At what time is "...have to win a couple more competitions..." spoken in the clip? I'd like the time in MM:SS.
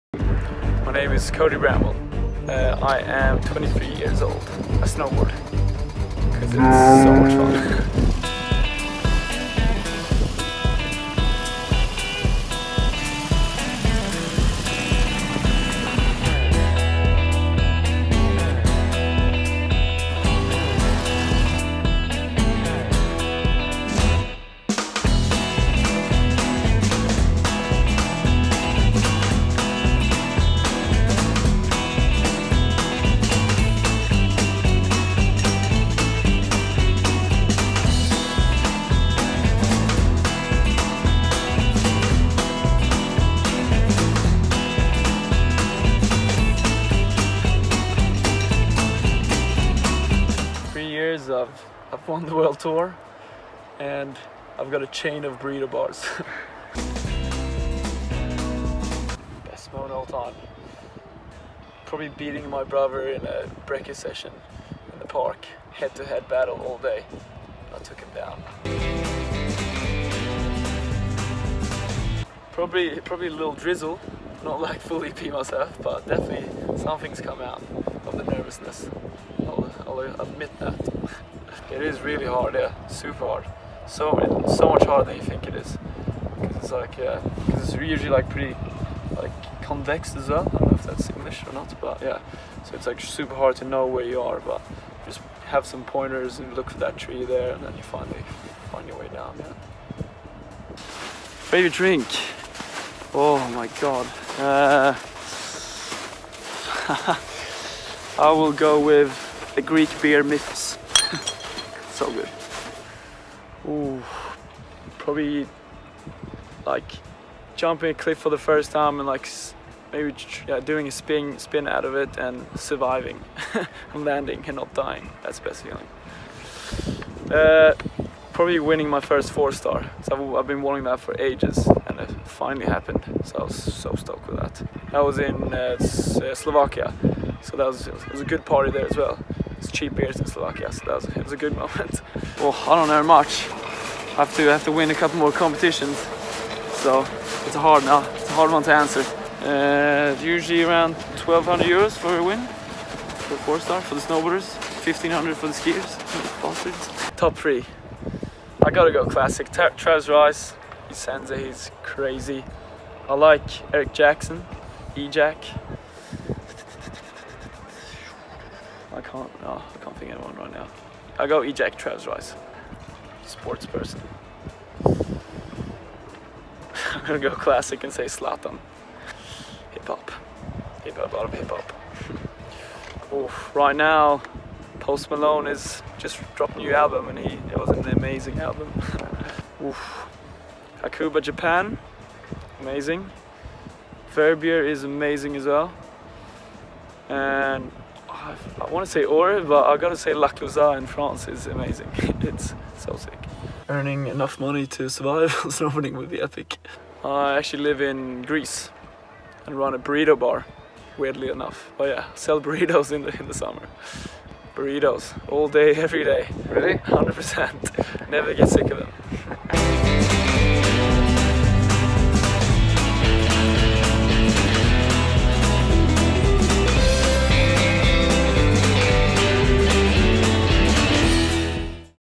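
02:24.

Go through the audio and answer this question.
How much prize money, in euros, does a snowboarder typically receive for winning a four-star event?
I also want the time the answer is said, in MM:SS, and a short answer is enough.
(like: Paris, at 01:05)
1,200 euros, at 02:31.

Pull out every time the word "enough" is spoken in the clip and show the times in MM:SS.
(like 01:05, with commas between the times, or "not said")
03:24, 03:31.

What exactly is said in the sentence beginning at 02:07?
Uh, probably winning my first four star.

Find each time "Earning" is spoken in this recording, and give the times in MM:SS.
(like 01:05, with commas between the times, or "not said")
03:23.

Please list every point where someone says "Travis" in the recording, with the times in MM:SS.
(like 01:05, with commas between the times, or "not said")
02:39, 02:51.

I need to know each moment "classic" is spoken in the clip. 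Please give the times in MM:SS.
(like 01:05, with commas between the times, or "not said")
02:39, 02:57.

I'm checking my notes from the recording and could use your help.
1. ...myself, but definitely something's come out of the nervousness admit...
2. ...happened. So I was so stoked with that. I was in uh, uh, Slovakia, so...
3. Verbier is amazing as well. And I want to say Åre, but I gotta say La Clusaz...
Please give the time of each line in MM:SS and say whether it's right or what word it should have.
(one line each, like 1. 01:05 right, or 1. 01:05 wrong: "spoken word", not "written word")
1. 01:15 right
2. 02:12 right
3. 03:14 right.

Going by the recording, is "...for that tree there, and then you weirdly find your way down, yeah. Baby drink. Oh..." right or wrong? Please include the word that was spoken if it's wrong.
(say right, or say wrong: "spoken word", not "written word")
wrong: "finally", not "weirdly".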